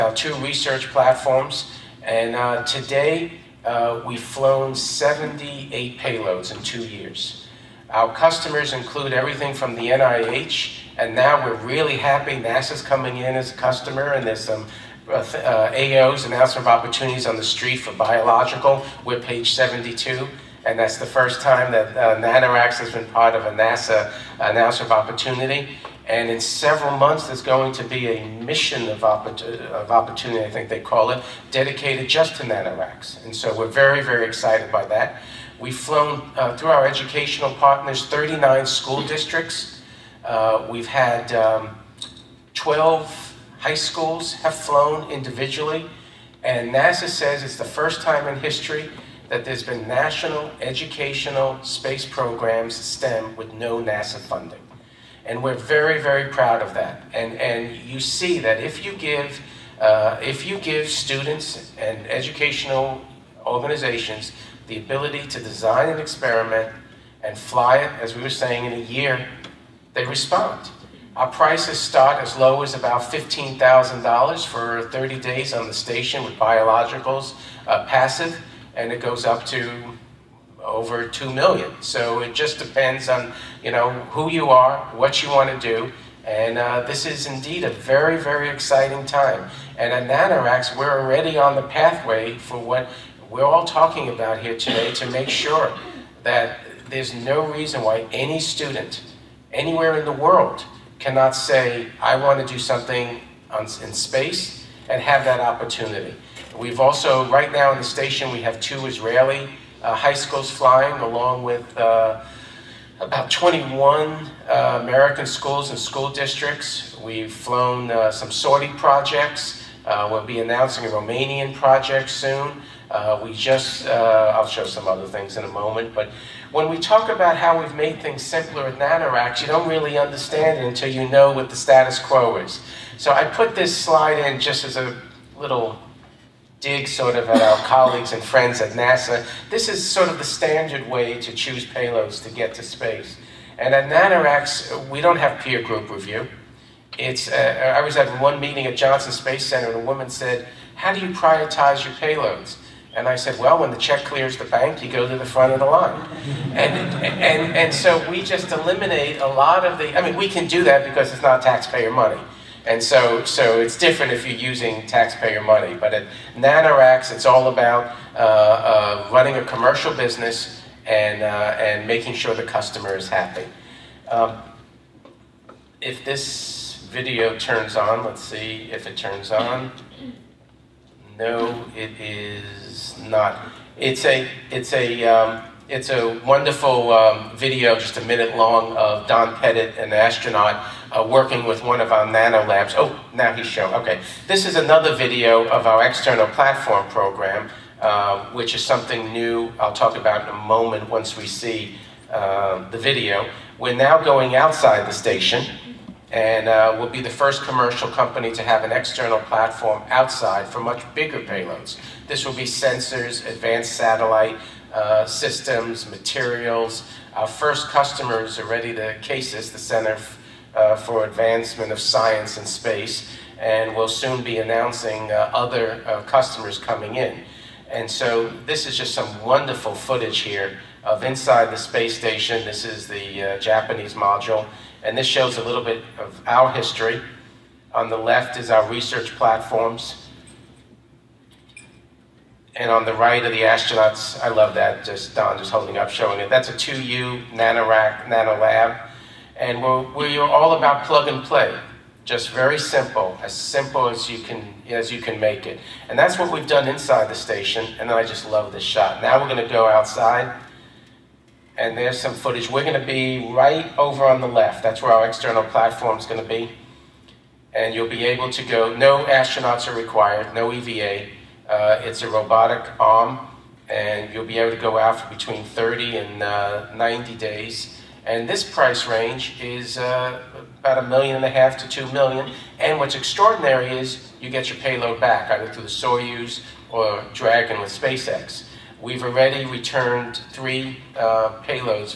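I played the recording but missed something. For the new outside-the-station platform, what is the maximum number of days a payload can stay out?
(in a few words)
90 days.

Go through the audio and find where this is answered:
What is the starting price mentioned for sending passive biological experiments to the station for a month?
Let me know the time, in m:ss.
1:13.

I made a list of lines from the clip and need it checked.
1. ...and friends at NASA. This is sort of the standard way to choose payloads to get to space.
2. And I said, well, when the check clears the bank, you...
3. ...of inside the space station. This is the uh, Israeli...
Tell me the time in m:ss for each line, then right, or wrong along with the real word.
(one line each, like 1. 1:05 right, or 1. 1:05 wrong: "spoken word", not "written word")
1. 2:18 right
2. 2:32 right
3. 3:50 wrong: "Japanese", not "Israeli".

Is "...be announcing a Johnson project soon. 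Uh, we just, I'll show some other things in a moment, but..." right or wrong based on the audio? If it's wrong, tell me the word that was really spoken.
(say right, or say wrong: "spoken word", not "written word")
wrong: "Romanian", not "Johnson".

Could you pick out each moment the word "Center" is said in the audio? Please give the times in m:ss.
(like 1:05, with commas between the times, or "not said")
2:29, 3:39.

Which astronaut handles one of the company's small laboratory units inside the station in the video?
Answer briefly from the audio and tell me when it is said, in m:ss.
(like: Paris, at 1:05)
Don Pettit, at 3:09.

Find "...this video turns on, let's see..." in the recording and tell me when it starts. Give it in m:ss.
2:56.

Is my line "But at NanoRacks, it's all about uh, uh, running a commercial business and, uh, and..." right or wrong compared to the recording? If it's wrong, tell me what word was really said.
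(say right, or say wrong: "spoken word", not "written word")
right.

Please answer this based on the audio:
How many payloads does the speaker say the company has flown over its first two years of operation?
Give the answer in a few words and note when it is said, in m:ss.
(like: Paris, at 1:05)
78, at 0:04.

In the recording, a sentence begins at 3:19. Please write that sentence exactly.
I'll talk about in a moment once we see uh, the video.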